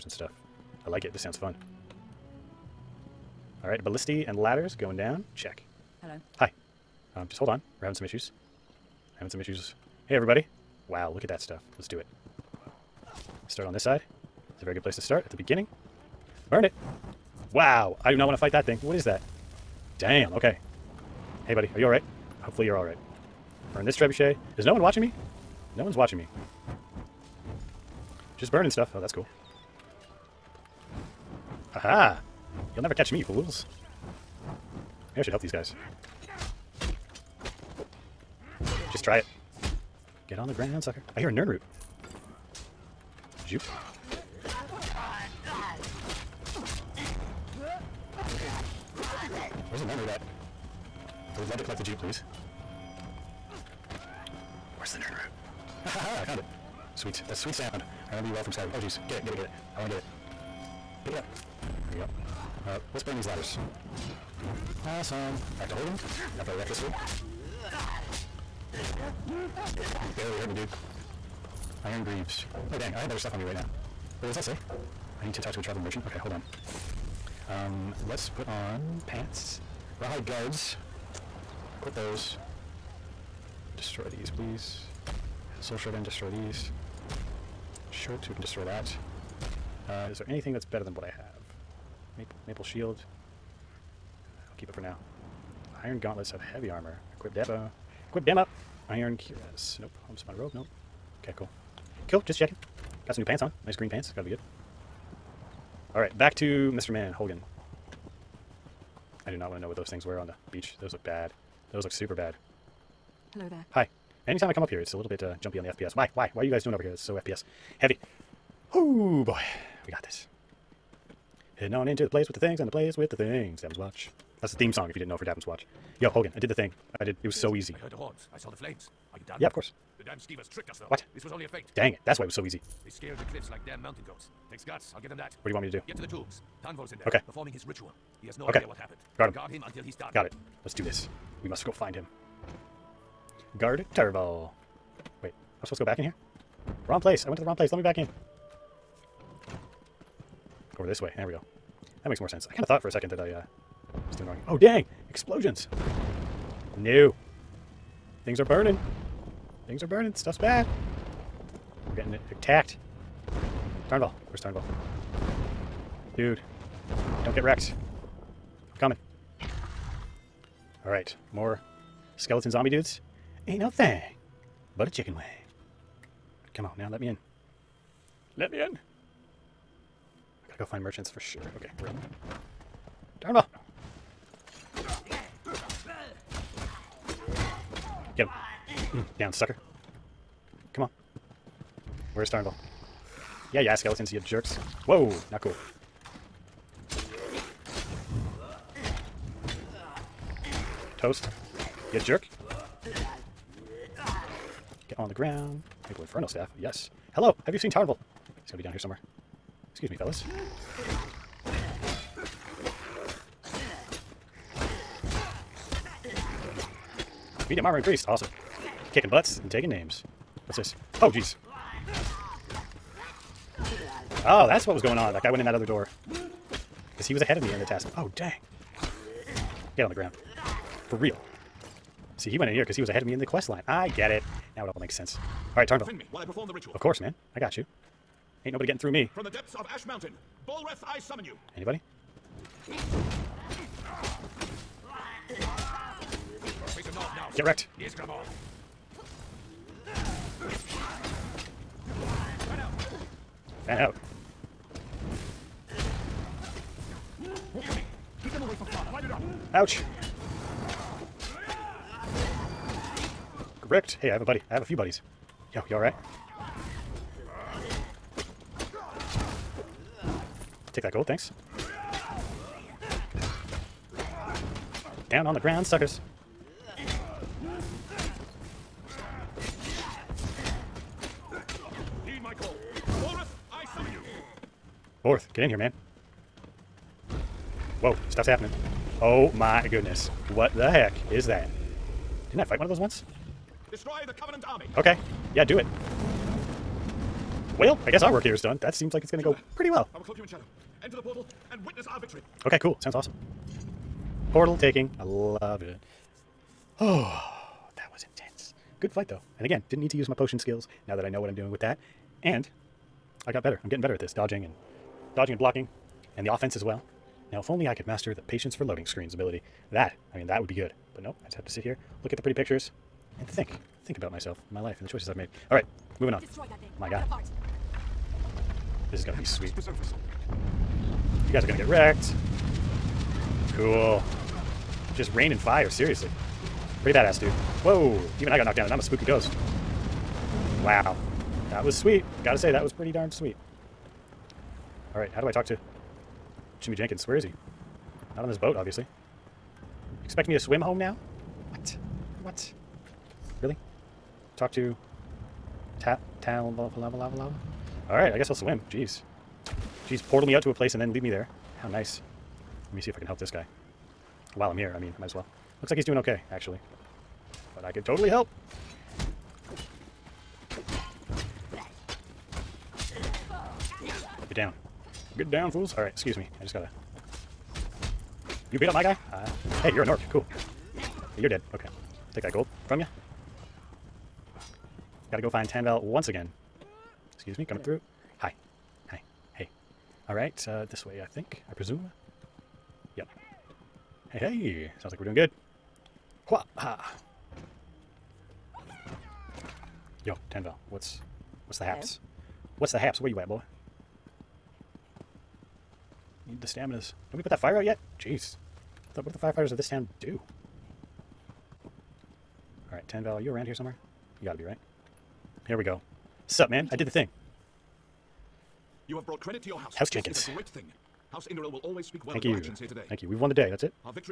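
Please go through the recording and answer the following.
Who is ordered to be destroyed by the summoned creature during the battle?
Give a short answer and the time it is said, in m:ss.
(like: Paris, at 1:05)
The Covenant army, at 4:54.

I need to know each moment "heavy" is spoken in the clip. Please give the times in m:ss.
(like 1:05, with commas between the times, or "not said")
1:36, 1:57.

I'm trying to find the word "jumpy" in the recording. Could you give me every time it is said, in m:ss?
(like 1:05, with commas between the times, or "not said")
1:55.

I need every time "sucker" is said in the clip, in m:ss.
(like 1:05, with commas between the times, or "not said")
0:40, 3:09, 4:35.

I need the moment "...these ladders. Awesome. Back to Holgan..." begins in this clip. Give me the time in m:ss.
1:03.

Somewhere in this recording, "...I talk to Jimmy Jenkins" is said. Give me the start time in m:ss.
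5:45.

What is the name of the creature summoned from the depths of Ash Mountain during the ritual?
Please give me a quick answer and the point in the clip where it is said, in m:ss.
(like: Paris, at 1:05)
Balreth, at 4:00.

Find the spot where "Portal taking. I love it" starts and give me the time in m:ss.
5:04.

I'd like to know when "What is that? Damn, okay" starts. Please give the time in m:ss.
0:18.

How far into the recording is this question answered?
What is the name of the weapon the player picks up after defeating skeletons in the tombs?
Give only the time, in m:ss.
3:25.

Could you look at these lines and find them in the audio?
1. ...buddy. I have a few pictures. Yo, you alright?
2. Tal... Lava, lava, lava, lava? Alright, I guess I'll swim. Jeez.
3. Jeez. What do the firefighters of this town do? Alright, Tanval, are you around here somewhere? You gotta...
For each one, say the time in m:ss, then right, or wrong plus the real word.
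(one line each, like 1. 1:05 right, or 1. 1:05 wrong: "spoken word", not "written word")
1. 4:24 wrong: "buddies", not "pictures"
2. 5:56 right
3. 6:47 right.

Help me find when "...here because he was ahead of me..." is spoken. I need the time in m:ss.
3:52.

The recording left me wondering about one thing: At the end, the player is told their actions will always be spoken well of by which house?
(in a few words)
House Indoril.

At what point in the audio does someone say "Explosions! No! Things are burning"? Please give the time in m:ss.
2:35.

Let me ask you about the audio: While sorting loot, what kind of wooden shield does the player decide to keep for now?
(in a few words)
Maple shield.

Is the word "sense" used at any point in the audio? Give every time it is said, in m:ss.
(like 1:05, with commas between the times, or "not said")
2:32, 3:54.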